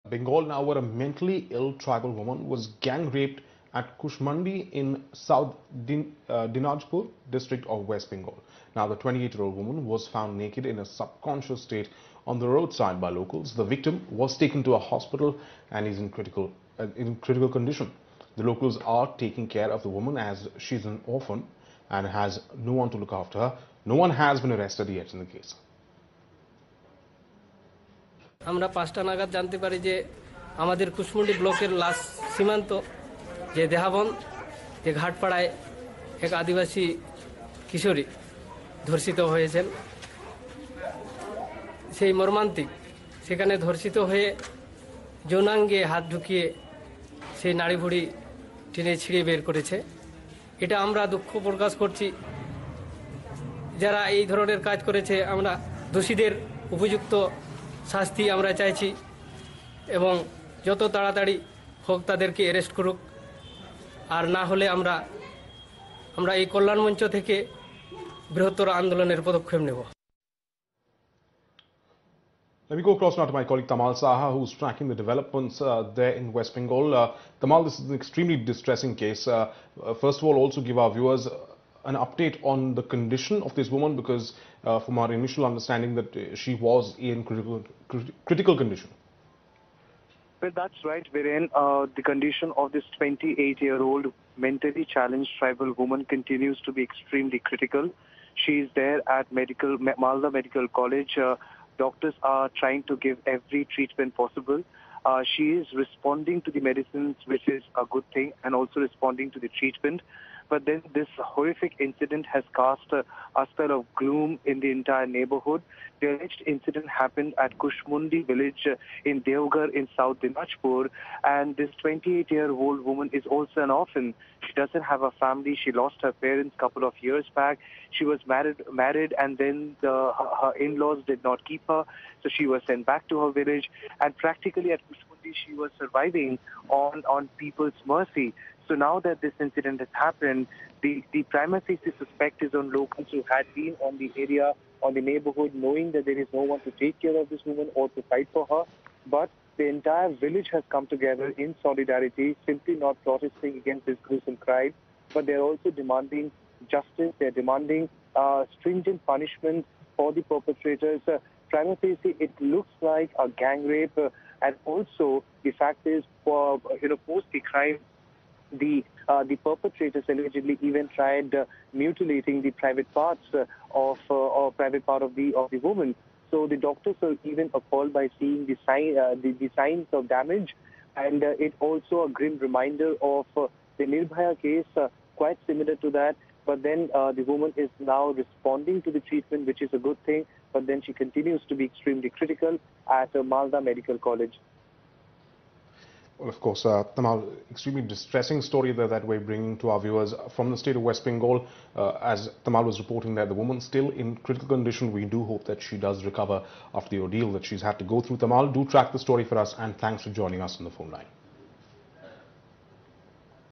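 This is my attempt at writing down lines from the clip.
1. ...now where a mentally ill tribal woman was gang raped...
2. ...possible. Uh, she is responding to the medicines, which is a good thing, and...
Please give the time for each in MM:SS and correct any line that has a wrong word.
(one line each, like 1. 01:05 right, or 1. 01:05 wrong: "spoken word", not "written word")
1. 00:00 right
2. 01:44 right.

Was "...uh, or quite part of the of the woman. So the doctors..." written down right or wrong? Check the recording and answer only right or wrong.
wrong.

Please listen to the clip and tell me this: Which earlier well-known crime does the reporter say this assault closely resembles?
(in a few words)
Nirbhaya case.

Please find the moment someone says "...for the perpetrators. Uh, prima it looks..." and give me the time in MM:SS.
02:39.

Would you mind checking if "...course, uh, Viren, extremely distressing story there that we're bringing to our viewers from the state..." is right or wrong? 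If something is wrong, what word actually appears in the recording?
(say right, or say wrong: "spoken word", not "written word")
wrong: "Tamal", not "Viren".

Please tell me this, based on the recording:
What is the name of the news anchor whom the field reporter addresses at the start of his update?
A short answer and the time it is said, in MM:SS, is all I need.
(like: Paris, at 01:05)
Viren, at 01:31.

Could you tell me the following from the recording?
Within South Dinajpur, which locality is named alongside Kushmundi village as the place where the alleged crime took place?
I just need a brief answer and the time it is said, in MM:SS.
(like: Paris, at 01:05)
Devgarh, at 01:59.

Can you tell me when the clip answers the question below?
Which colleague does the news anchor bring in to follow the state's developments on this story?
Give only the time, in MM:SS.
01:13.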